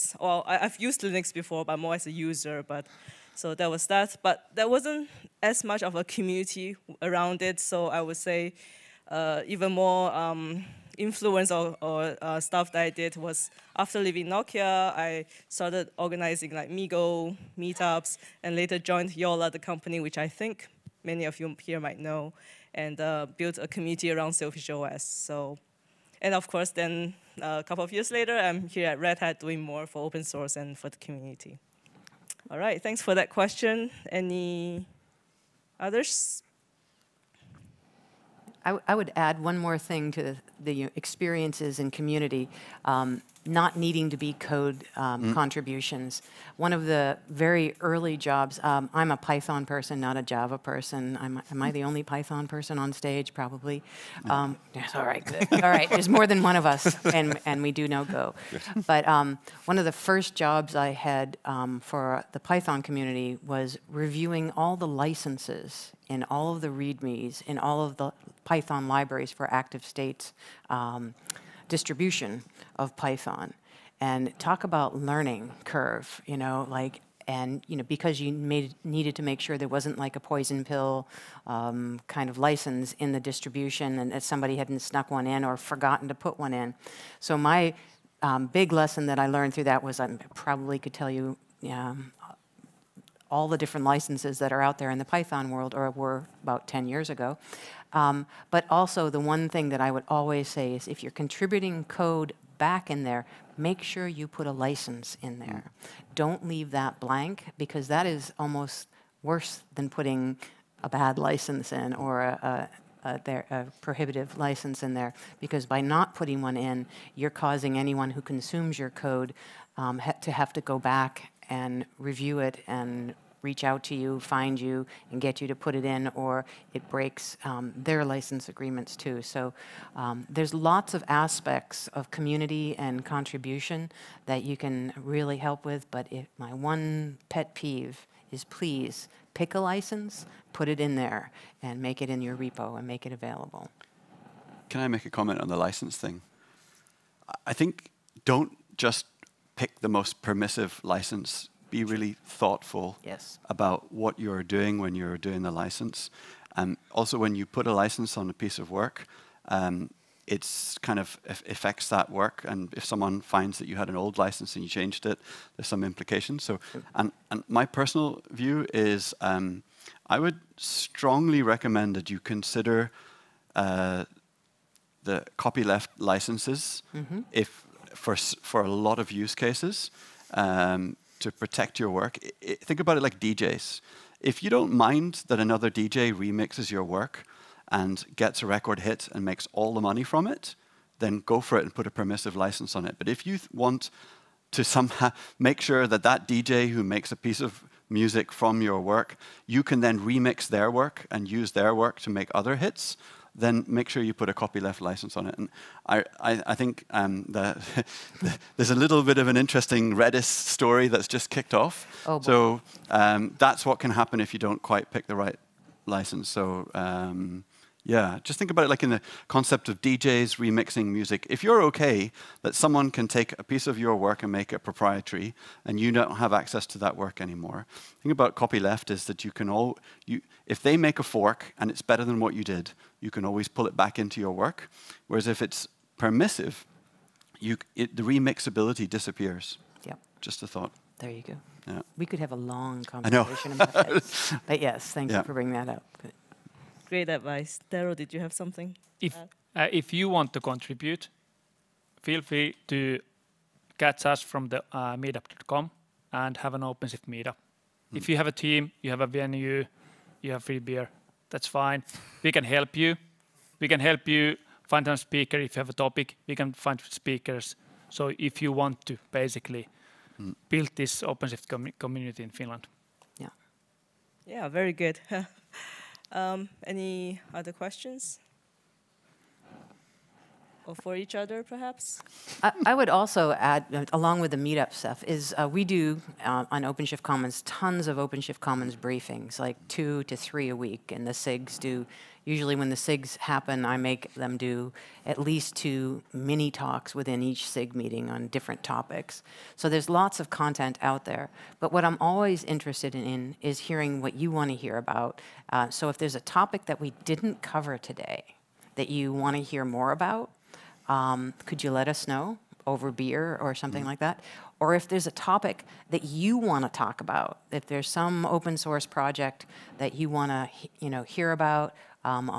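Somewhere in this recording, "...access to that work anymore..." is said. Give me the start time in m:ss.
3:46.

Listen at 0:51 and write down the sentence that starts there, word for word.
I'm, am I the only Python person on stage?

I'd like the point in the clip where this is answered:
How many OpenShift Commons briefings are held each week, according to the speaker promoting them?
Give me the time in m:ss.
4:49.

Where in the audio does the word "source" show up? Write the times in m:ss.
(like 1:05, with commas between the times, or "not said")
0:30, 5:18.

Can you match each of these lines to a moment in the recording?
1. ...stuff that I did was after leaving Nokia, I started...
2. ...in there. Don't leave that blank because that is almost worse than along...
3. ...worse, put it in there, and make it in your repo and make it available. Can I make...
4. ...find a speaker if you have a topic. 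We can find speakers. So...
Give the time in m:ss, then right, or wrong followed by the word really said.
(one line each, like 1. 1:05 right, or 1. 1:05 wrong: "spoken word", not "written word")
1. 0:12 right
2. 1:45 wrong: "putting", not "along"
3. 2:19 wrong: "license", not "worse"
4. 4:24 right.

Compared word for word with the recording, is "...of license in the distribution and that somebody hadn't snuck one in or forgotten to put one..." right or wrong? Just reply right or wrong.
right.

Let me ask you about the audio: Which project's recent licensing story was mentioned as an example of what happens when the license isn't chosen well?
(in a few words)
Redis.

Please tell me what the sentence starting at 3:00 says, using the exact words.
Um, to protect your work, it, it, think about it like DJs.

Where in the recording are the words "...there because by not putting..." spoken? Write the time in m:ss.
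1:54.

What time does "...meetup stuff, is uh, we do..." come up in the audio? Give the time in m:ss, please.
4:44.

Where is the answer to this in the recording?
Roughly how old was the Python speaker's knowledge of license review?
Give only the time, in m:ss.
1:36.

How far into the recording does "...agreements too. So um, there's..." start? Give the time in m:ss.
2:08.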